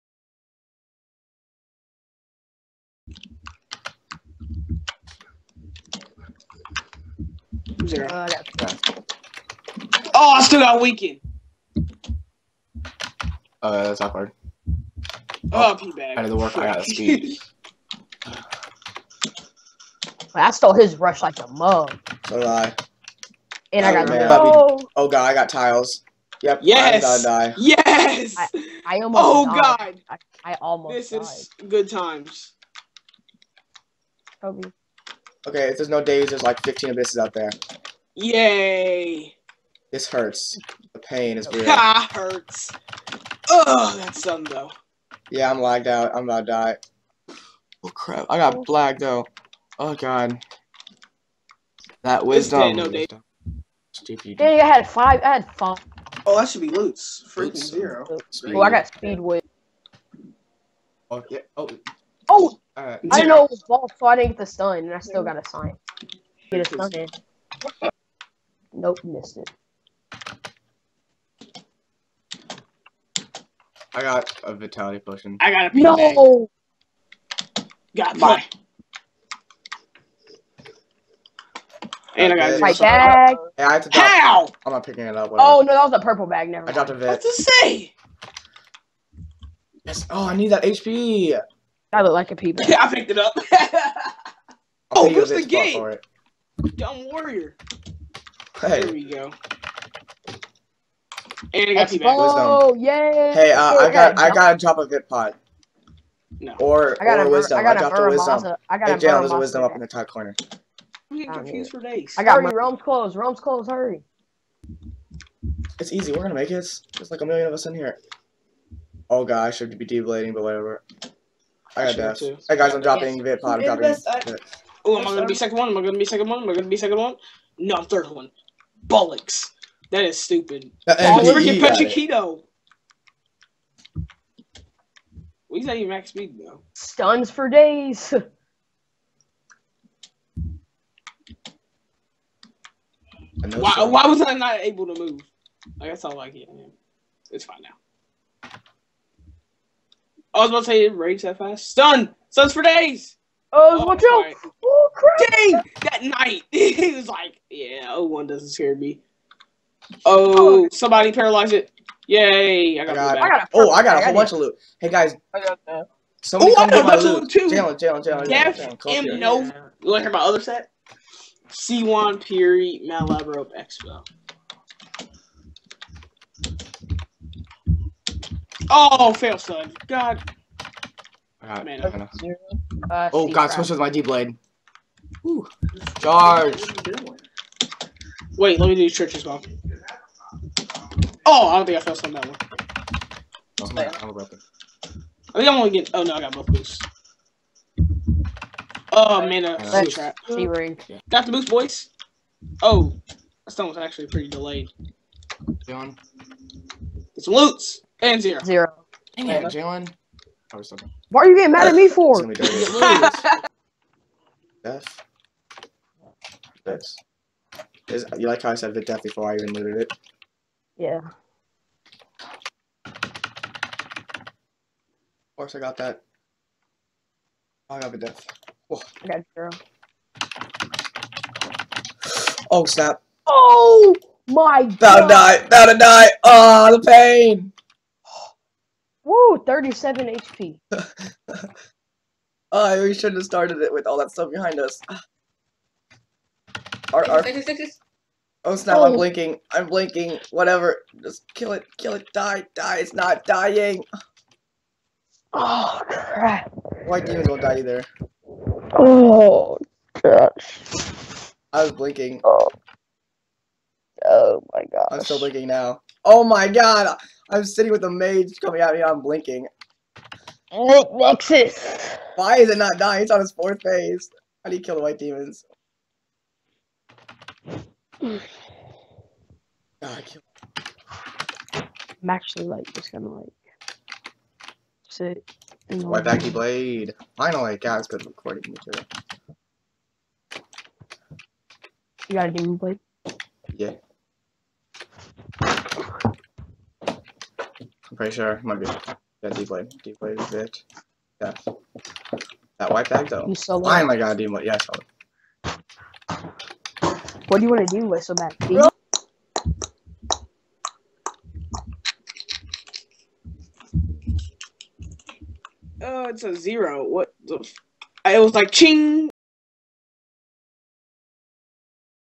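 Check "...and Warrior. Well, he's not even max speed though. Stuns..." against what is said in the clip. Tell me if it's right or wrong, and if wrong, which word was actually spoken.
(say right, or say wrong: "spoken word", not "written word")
wrong: "Pachequito", not "Warrior".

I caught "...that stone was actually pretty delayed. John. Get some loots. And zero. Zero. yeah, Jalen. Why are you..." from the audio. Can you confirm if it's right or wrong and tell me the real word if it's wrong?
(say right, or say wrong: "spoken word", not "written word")
right.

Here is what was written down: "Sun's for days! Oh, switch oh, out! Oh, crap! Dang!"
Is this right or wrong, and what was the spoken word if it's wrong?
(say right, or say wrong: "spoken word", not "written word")
wrong: "watch", not "switch".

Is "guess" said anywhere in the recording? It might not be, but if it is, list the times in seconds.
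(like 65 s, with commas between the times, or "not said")
145 s.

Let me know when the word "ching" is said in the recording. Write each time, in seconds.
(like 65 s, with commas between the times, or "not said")
318 s.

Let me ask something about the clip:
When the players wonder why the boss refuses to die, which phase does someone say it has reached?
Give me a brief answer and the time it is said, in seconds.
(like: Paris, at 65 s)
fourth phase, at 273 s.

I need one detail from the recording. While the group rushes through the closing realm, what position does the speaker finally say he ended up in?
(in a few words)
third.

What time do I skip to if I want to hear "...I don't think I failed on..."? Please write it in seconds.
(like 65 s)
191 s.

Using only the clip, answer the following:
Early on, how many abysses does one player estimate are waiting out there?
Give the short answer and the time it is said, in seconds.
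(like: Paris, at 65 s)
15, at 36 s.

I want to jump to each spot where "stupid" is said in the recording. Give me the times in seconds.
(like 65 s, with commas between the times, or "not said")
53 s, 130 s.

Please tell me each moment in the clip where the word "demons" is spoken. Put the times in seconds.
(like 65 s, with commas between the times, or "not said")
256 s, 274 s, 292 s.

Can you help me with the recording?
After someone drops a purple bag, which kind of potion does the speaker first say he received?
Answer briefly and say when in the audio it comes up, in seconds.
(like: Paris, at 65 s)
vitality potion, at 74 s.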